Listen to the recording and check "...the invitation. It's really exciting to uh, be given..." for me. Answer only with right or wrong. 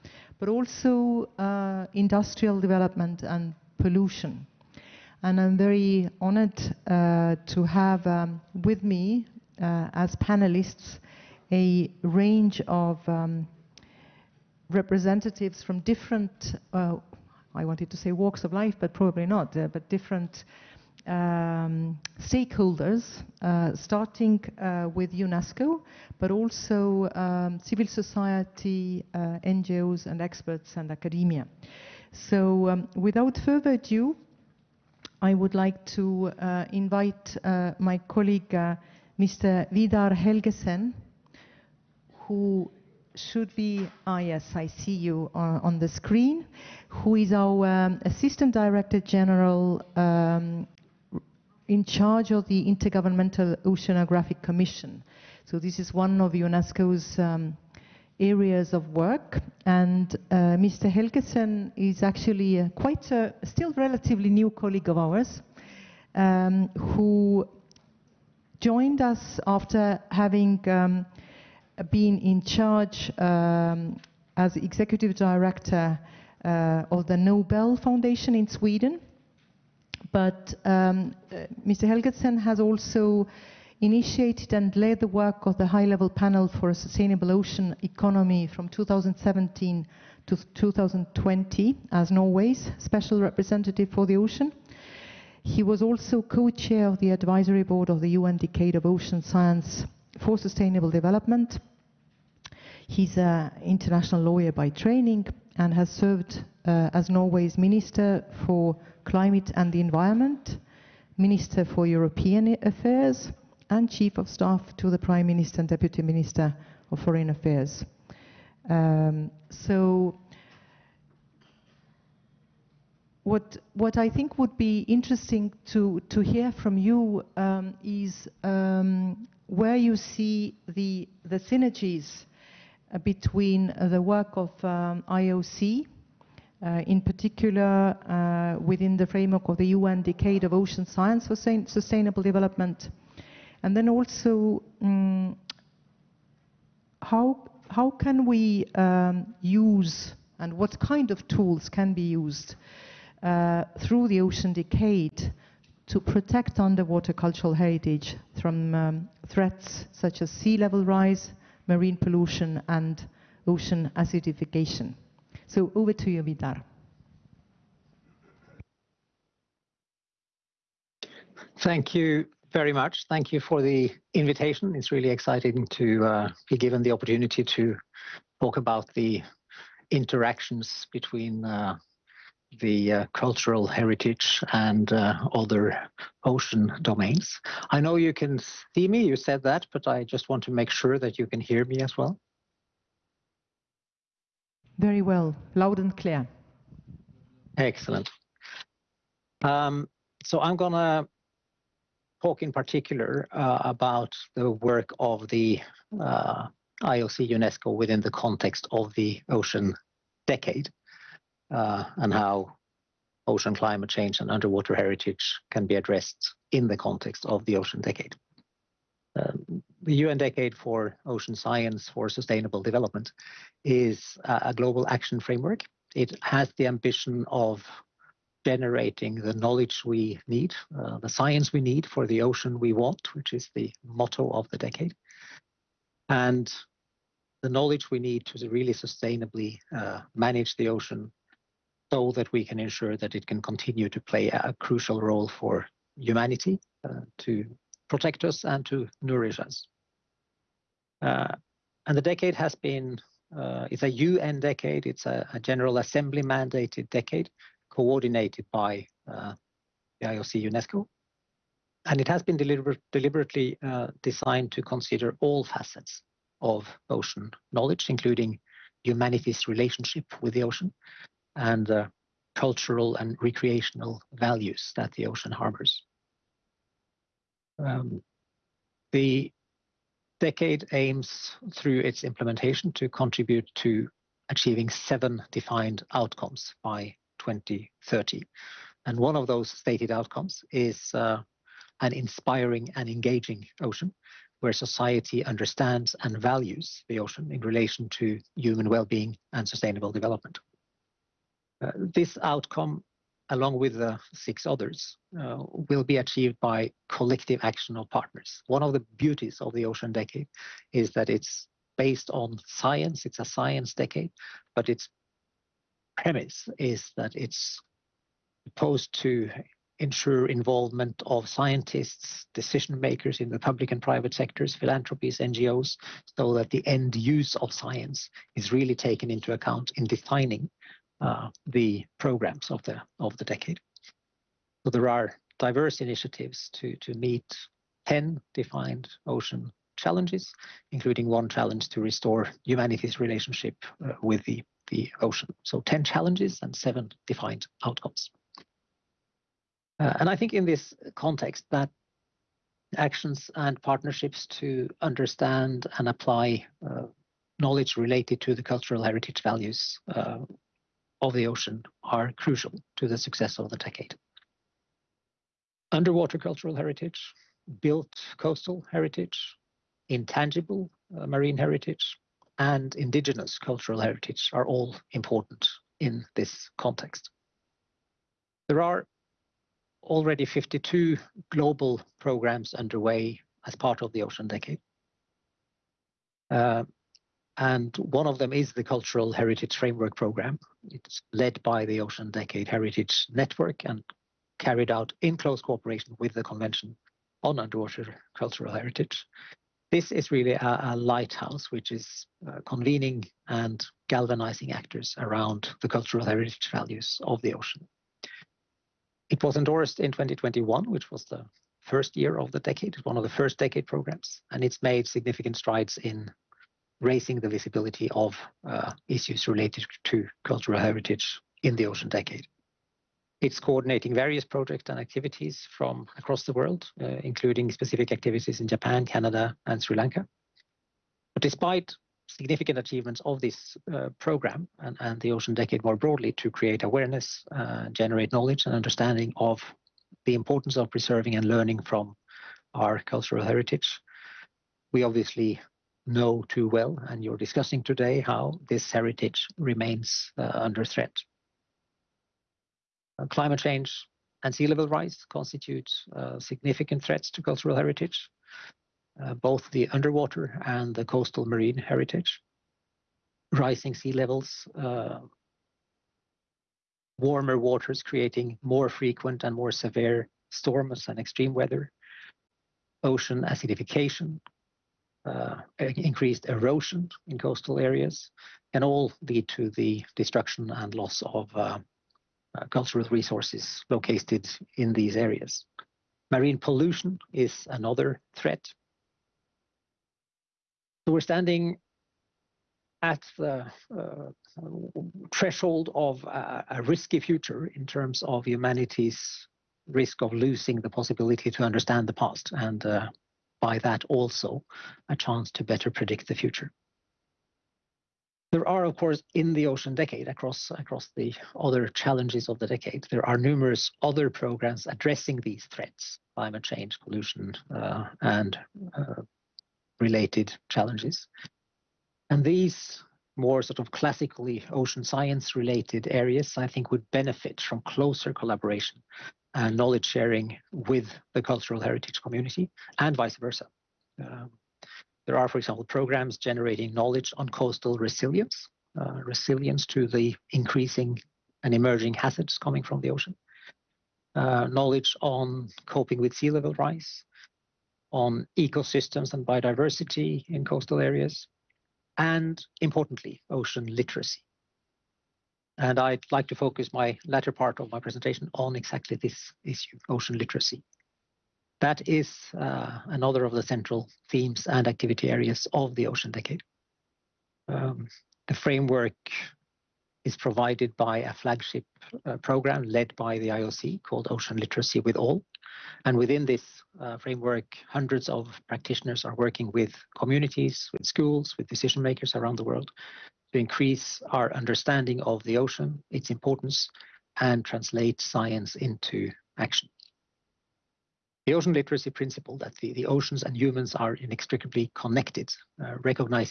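right.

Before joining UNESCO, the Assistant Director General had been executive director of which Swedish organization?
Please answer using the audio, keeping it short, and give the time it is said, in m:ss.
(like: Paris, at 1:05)
Nobel Foundation, at 1:17.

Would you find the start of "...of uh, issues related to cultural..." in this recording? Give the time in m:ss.
6:57.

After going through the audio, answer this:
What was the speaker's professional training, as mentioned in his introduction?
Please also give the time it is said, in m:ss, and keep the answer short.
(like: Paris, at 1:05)
International lawyer, at 1:43.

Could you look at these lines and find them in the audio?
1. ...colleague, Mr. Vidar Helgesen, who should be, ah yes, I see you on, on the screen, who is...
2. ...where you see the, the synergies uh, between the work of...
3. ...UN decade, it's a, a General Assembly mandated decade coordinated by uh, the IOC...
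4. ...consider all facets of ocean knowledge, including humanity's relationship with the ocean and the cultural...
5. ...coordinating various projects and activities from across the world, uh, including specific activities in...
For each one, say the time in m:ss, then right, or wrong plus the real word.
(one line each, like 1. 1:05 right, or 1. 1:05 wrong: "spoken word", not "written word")
1. 0:38 right
2. 2:09 right
3. 4:13 right
4. 4:24 right
5. 7:03 right.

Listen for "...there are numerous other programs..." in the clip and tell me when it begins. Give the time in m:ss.
8:32.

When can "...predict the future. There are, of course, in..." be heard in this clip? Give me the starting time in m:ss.
8:25.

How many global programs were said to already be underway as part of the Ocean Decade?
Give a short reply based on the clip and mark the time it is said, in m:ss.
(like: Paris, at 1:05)
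52, at 6:20.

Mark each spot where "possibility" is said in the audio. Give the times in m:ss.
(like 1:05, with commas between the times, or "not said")
8:20.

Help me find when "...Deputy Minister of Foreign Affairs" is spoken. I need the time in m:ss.
1:55.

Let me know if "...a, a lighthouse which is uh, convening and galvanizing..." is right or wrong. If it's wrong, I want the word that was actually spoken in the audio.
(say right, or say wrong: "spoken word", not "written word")
right.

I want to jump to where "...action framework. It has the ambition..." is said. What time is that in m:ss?
3:44.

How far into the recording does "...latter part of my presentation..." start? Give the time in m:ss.
9:17.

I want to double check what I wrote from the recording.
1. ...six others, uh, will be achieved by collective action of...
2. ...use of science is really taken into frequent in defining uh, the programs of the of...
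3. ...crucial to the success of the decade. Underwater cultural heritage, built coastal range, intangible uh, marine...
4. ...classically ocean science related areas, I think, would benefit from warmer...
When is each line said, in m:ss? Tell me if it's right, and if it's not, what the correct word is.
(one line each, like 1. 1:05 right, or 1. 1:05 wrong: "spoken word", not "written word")
1. 5:04 right
2. 5:26 wrong: "account", not "frequent"
3. 6:02 wrong: "heritage", not "range"
4. 8:43 wrong: "closer", not "warmer".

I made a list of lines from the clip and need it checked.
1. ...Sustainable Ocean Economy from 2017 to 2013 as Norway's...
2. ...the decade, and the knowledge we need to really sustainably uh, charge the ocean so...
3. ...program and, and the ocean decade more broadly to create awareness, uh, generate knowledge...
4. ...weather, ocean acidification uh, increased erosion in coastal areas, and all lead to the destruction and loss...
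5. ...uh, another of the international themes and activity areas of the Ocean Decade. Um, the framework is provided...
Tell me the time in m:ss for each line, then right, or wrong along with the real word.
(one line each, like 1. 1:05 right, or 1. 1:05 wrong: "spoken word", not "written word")
1. 1:26 wrong: "2020", not "2013"
2. 3:54 wrong: "manage", not "charge"
3. 7:13 right
4. 7:51 right
5. 9:22 wrong: "central", not "international".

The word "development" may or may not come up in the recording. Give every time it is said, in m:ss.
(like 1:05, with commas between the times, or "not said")
0:02, 1:40, 2:22, 3:42, 4:59.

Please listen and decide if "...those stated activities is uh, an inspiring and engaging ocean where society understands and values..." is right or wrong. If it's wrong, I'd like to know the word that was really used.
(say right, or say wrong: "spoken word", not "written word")
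wrong: "outcomes", not "activities".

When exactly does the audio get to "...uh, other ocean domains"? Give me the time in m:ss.
3:04.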